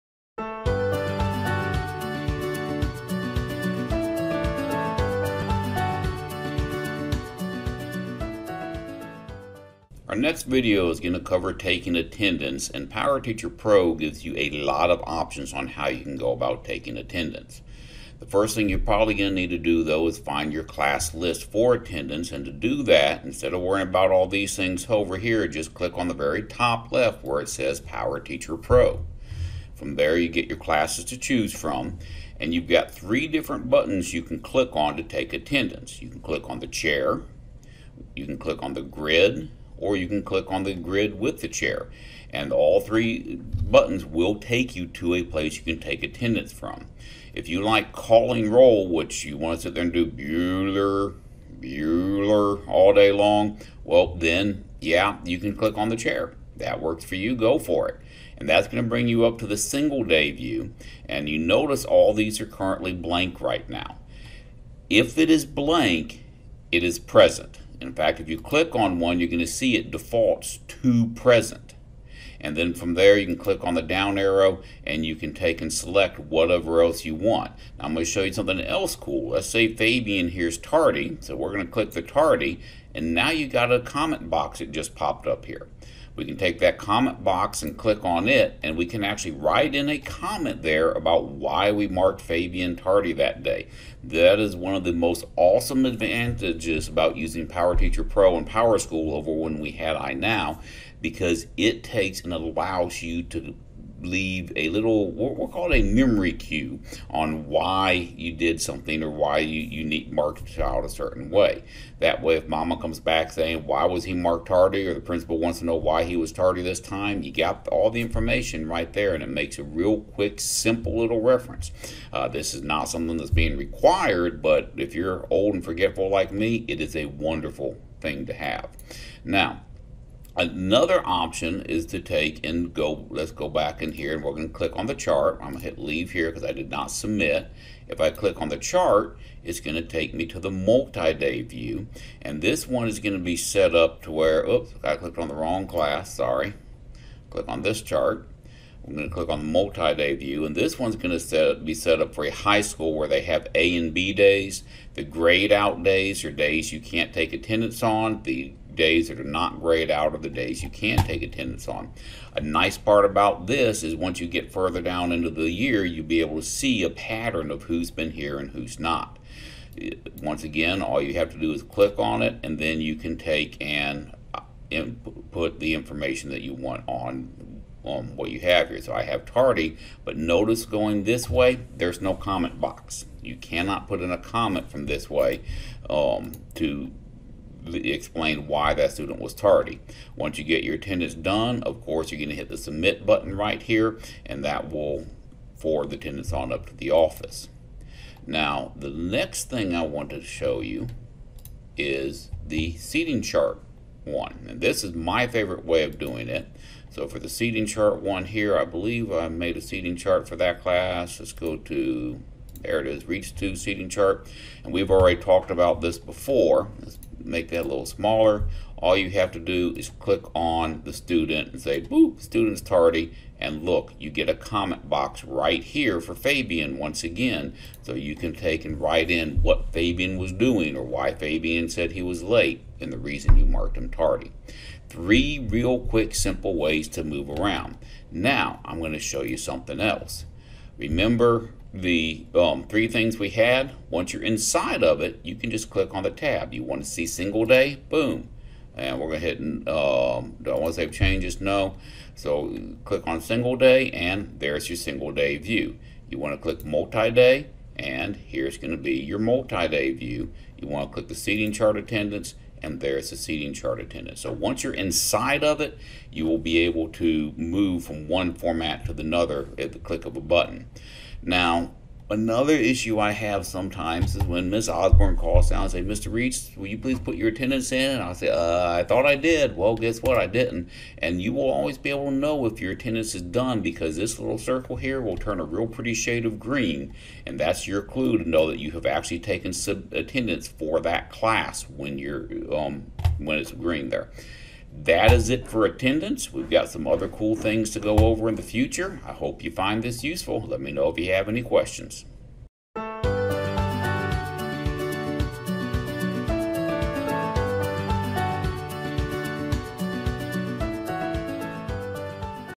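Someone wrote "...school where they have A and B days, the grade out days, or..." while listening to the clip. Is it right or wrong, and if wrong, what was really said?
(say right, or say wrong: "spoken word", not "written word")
right.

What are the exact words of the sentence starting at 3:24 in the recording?
And this is my favorite way of doing it.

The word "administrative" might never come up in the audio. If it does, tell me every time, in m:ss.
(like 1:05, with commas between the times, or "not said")
not said.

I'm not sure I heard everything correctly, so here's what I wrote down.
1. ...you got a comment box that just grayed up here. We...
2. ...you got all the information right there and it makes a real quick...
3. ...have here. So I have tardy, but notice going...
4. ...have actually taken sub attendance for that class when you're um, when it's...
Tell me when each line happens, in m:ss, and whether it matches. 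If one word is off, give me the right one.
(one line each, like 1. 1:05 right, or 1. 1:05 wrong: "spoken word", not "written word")
1. 1:23 wrong: "popped", not "grayed"
2. 1:57 right
3. 2:58 right
4. 4:48 right.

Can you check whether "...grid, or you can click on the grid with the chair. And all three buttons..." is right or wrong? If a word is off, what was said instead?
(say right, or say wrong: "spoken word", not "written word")
right.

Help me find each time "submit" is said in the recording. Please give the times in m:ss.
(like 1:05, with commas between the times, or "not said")
2:16, 3:12.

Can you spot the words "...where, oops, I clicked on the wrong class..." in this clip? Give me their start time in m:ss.
2:24.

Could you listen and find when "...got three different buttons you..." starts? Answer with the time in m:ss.
0:32.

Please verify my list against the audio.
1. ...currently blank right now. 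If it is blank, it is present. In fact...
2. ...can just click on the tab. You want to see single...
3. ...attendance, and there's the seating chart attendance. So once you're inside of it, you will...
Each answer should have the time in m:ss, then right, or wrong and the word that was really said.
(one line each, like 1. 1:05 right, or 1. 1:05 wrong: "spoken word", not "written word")
1. 1:02 right
2. 4:05 right
3. 4:21 right.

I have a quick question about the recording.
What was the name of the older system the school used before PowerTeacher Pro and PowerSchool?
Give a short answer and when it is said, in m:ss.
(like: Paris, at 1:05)
iNow, at 1:39.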